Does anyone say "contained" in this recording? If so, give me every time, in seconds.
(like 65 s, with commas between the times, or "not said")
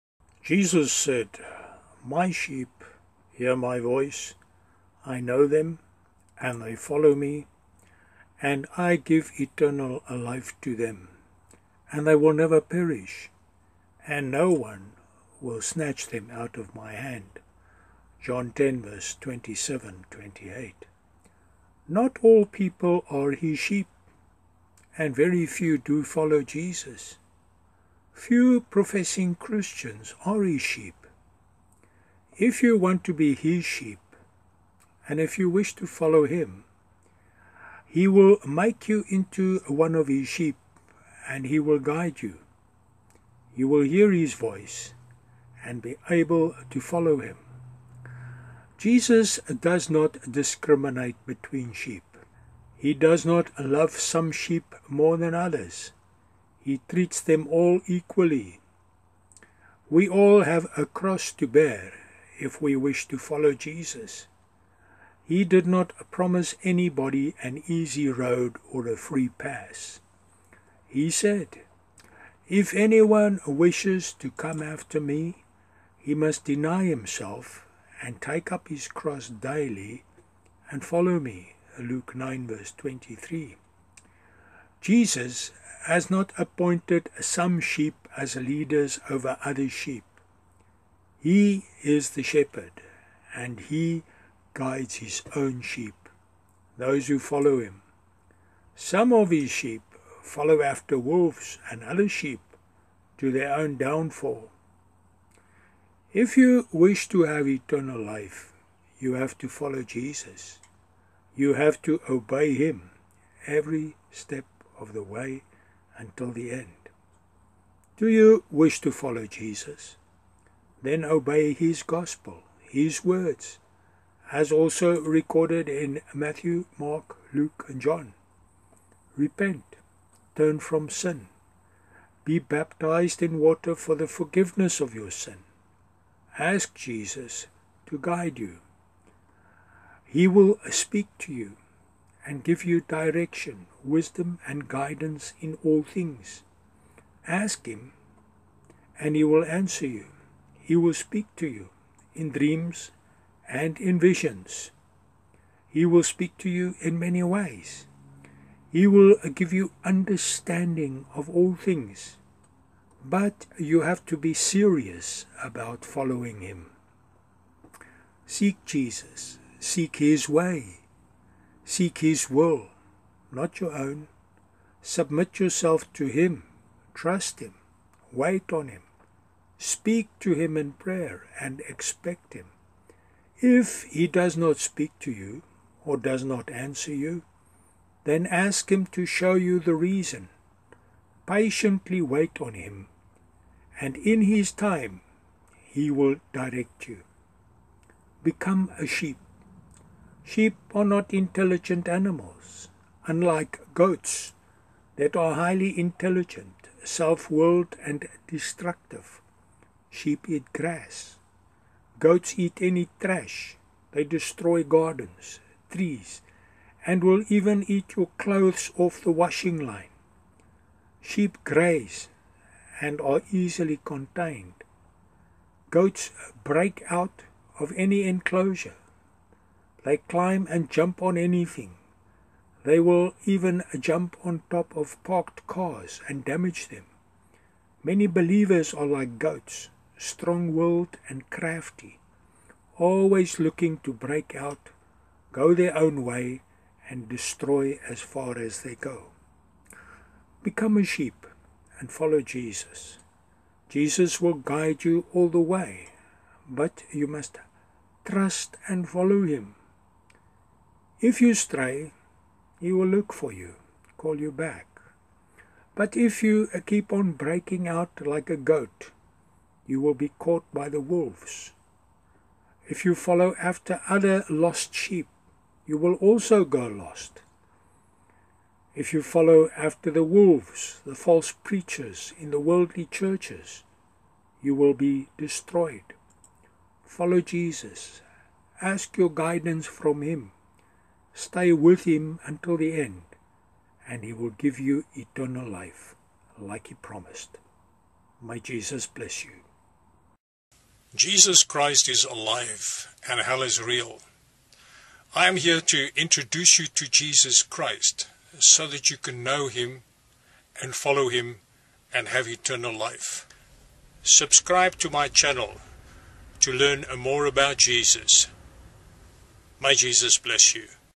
223 s.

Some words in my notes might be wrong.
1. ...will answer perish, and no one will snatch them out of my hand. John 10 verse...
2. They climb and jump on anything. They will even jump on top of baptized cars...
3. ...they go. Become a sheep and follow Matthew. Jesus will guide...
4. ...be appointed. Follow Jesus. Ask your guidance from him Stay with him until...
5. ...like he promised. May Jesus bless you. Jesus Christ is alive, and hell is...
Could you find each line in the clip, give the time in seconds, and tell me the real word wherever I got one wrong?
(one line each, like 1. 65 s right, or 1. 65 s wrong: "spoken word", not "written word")
1. 12 s wrong: "never", not "answer"
2. 229 s wrong: "parked", not "baptized"
3. 248 s wrong: "Jesus", not "Matthew"
4. 284 s wrong: "destroyed", not "appointed"
5. 296 s right.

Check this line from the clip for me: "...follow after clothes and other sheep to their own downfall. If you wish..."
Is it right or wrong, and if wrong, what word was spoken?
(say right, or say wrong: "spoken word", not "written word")
wrong: "wolves", not "clothes".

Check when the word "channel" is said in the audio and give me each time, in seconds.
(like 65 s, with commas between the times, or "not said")
315 s.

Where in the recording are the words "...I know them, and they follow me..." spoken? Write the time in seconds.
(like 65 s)
5 s.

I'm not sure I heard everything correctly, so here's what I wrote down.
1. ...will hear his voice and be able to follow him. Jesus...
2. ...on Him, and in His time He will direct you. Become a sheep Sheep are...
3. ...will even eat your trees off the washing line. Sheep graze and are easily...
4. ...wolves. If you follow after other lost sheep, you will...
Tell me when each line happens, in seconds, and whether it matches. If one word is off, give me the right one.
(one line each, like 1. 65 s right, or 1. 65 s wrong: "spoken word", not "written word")
1. 43 s right
2. 192 s right
3. 217 s wrong: "clothes", not "trees"
4. 270 s right.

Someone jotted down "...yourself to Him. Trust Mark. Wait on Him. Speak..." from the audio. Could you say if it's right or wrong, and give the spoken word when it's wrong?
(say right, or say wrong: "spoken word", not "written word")
wrong: "Him", not "Mark".